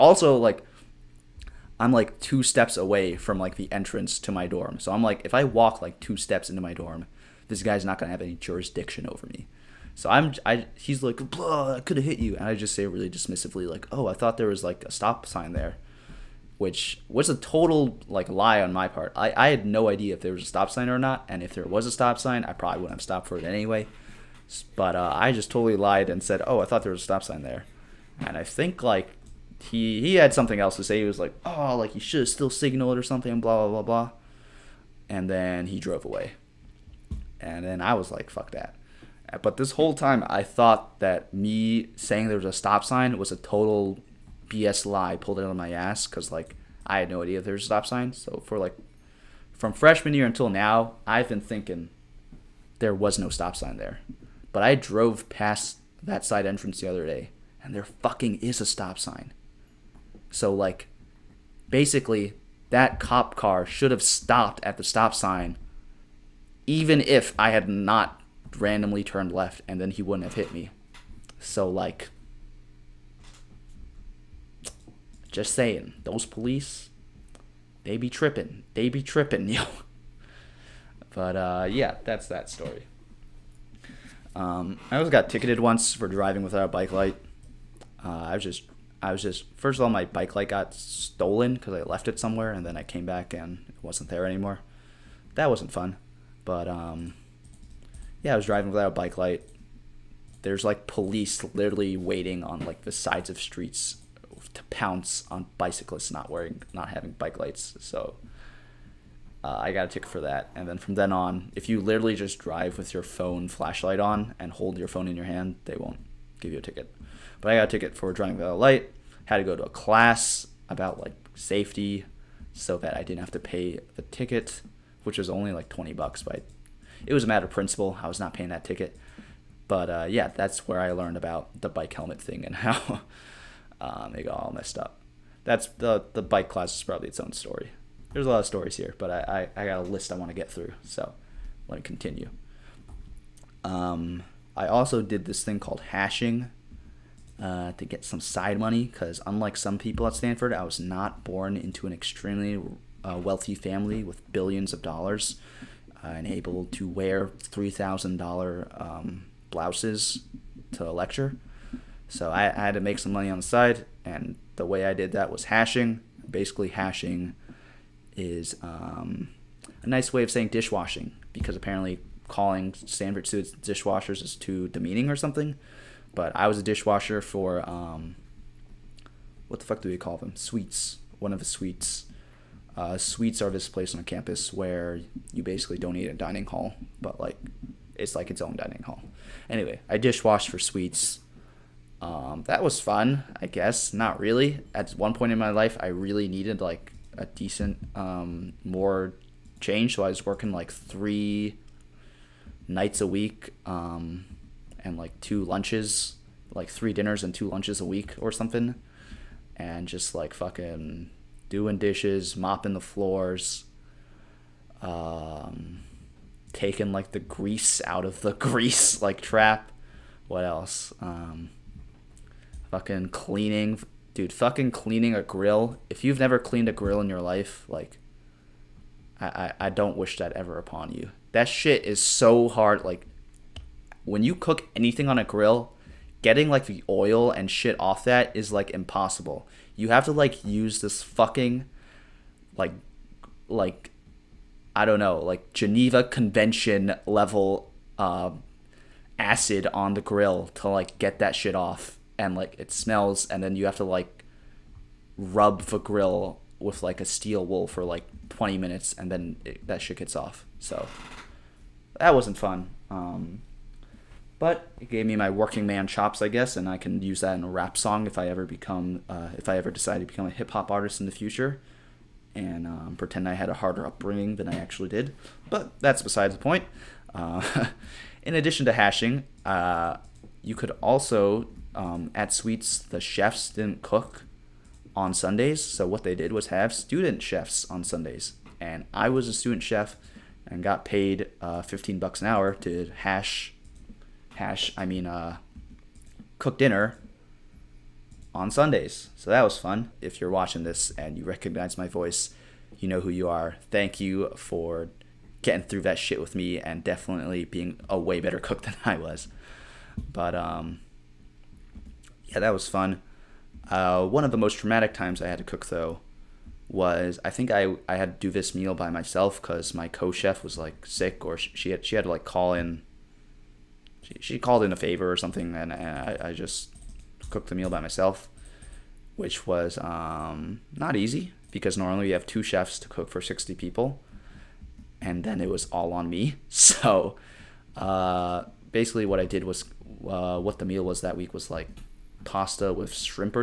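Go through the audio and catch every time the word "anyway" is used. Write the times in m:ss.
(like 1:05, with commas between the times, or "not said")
0:23, 3:09.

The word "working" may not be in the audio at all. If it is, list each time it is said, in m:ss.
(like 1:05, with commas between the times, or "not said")
3:20, 4:25.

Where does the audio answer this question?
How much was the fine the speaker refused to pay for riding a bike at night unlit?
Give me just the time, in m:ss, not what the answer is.
2:05.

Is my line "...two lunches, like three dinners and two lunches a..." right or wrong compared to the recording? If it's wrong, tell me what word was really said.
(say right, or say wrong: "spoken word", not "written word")
right.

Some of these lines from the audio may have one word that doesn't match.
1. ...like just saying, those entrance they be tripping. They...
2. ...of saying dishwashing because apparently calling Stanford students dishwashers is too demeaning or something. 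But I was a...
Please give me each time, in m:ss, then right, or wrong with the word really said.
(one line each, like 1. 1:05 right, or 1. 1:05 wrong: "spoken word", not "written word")
1. 1:11 wrong: "police", not "entrance"
2. 2:50 right.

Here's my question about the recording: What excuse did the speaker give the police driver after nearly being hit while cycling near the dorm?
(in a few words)
Thought there was a stop sign.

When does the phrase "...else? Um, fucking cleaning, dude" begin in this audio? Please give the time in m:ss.
3:40.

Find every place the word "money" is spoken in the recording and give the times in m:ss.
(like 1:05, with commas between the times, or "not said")
2:28, 2:43.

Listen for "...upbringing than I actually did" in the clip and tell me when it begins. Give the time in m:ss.
4:33.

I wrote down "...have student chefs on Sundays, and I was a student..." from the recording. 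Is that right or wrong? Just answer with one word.
right.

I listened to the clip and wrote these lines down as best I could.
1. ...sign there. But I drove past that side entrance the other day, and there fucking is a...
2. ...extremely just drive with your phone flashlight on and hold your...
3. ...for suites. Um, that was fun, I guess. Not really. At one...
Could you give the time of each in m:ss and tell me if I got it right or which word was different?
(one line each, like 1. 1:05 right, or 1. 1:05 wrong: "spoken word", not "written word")
1. 0:53 right
2. 1:51 wrong: "literally", not "extremely"
3. 3:10 right.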